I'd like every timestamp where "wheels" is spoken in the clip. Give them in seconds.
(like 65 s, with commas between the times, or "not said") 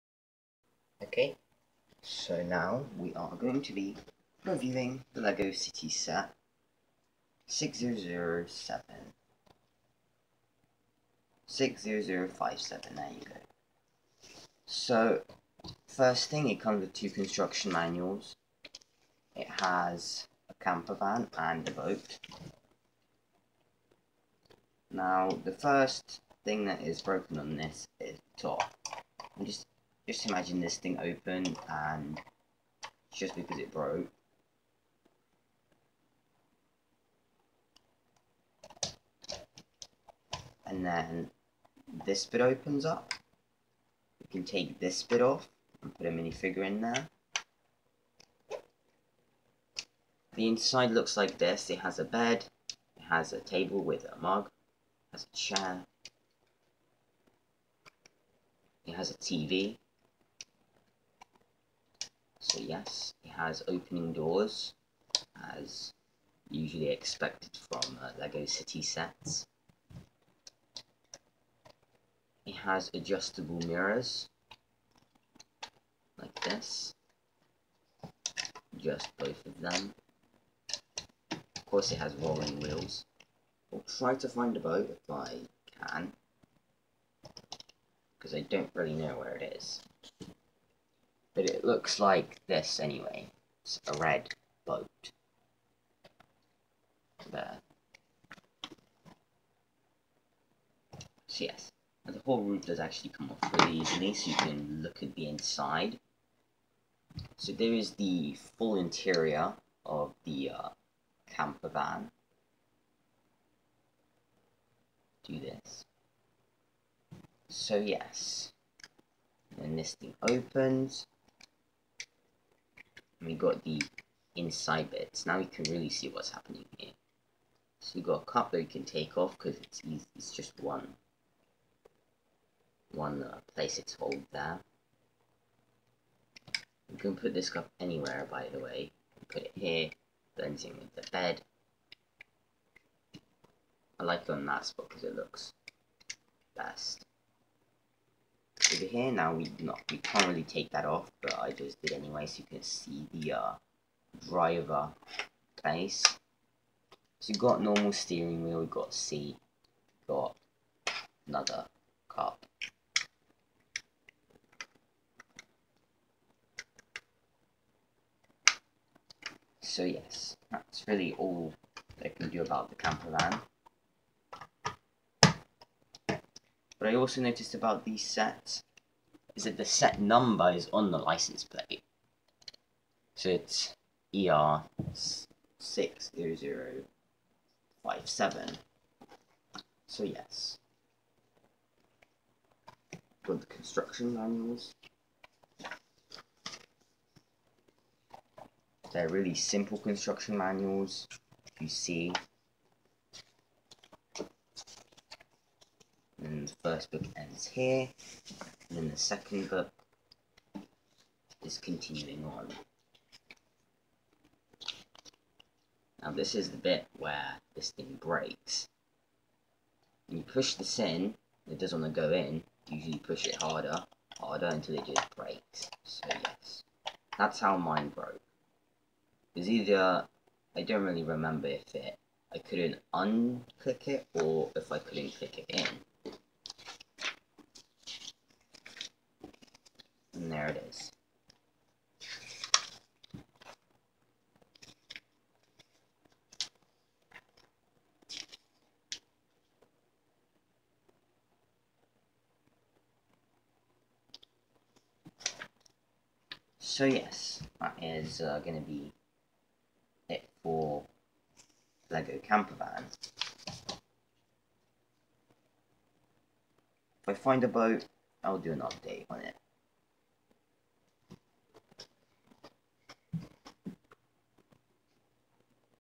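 82 s, 158 s.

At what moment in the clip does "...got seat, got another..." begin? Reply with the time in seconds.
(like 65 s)
158 s.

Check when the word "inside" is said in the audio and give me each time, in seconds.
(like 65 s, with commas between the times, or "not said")
50 s, 105 s, 124 s.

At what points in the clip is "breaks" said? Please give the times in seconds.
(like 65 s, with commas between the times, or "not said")
217 s, 225 s.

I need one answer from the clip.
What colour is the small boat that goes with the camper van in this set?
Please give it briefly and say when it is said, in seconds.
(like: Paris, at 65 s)
Red, at 93 s.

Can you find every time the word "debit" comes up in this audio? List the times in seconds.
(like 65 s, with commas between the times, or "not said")
not said.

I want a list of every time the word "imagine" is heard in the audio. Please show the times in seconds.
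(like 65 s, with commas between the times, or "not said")
30 s.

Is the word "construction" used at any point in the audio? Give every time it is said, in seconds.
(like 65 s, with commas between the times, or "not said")
17 s, 193 s, 199 s.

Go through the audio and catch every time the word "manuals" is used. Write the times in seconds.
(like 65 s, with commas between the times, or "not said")
17 s, 194 s, 200 s.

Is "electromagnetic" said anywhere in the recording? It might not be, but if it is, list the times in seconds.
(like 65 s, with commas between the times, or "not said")
not said.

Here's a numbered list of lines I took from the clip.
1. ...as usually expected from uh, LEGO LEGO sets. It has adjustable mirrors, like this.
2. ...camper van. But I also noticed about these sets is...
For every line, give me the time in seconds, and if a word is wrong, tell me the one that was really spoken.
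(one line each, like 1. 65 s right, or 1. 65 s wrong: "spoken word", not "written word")
1. 65 s wrong: "City", not "LEGO"
2. 172 s right.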